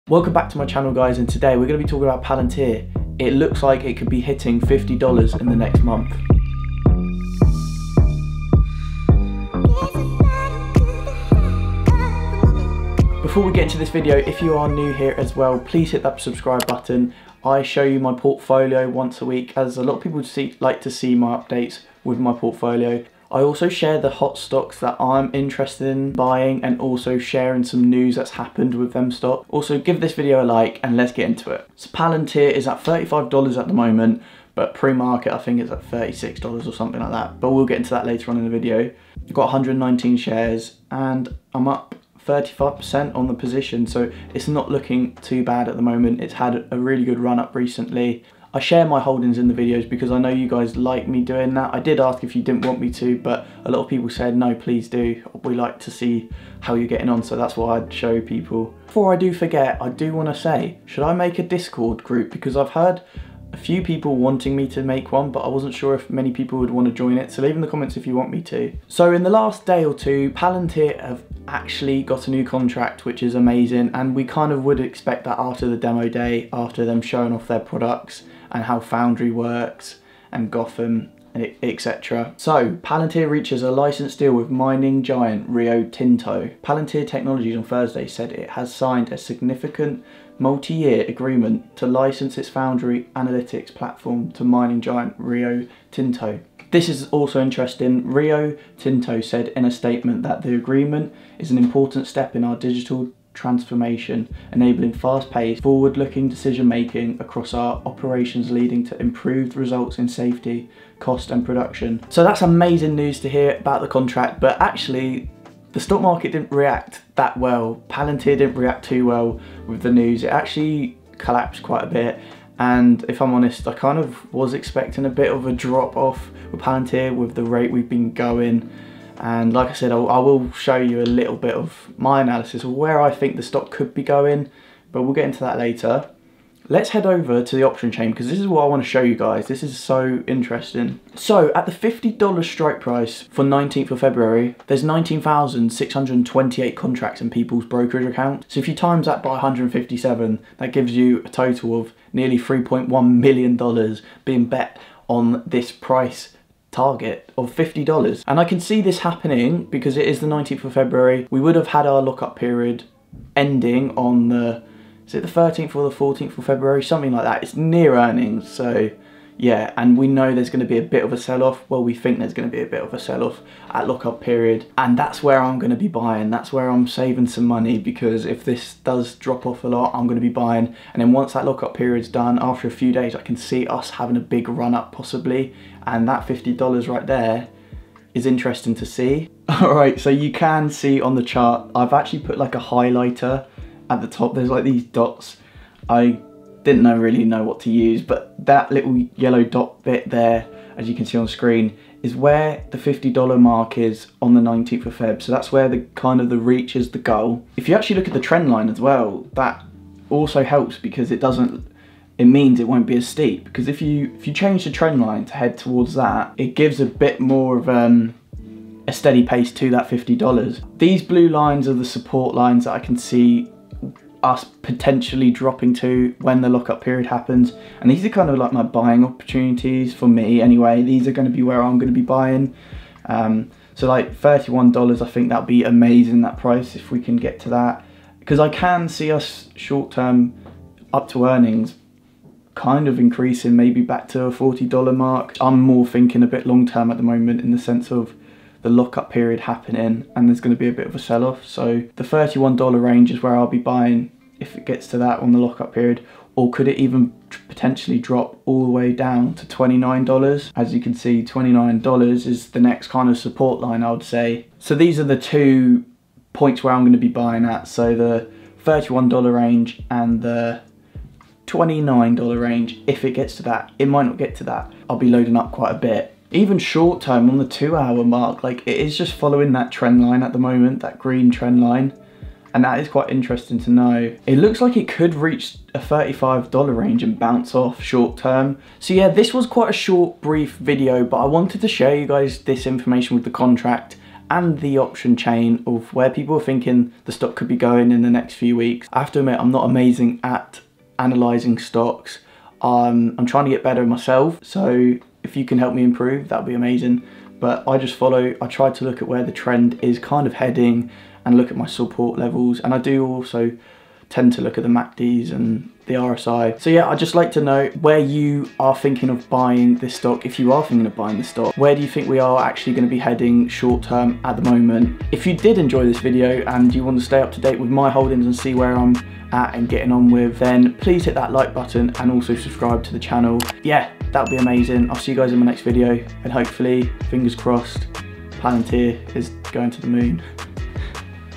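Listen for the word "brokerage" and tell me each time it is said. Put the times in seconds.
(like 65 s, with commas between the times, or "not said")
147 s.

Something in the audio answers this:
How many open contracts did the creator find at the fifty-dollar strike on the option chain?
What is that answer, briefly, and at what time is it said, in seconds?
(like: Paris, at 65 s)
19,628, at 144 s.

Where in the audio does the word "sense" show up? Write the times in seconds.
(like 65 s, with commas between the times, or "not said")
247 s.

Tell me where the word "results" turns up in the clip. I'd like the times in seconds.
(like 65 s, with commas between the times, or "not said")
109 s.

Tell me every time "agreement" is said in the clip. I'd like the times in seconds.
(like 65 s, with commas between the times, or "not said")
91 s, 100 s.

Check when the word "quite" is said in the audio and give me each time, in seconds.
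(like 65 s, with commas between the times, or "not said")
121 s, 275 s, 282 s, 289 s.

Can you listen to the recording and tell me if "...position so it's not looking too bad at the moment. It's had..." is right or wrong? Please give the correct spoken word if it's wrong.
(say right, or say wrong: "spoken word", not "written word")
right.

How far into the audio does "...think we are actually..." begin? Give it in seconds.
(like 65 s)
321 s.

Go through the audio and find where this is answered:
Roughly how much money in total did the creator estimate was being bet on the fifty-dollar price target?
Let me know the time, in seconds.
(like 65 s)
152 s.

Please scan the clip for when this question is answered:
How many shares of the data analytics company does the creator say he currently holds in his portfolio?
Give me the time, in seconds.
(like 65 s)
39 s.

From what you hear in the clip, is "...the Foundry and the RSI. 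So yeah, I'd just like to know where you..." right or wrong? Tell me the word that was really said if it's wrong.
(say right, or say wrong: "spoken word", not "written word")
wrong: "MACDs", not "Foundry".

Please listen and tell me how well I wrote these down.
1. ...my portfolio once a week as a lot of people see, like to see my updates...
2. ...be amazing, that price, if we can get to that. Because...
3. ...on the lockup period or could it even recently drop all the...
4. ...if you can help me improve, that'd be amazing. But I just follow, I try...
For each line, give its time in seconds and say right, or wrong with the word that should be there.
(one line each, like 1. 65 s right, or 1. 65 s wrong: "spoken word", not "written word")
1. 17 s right
2. 235 s right
3. 255 s wrong: "potentially", not "recently"
4. 305 s right.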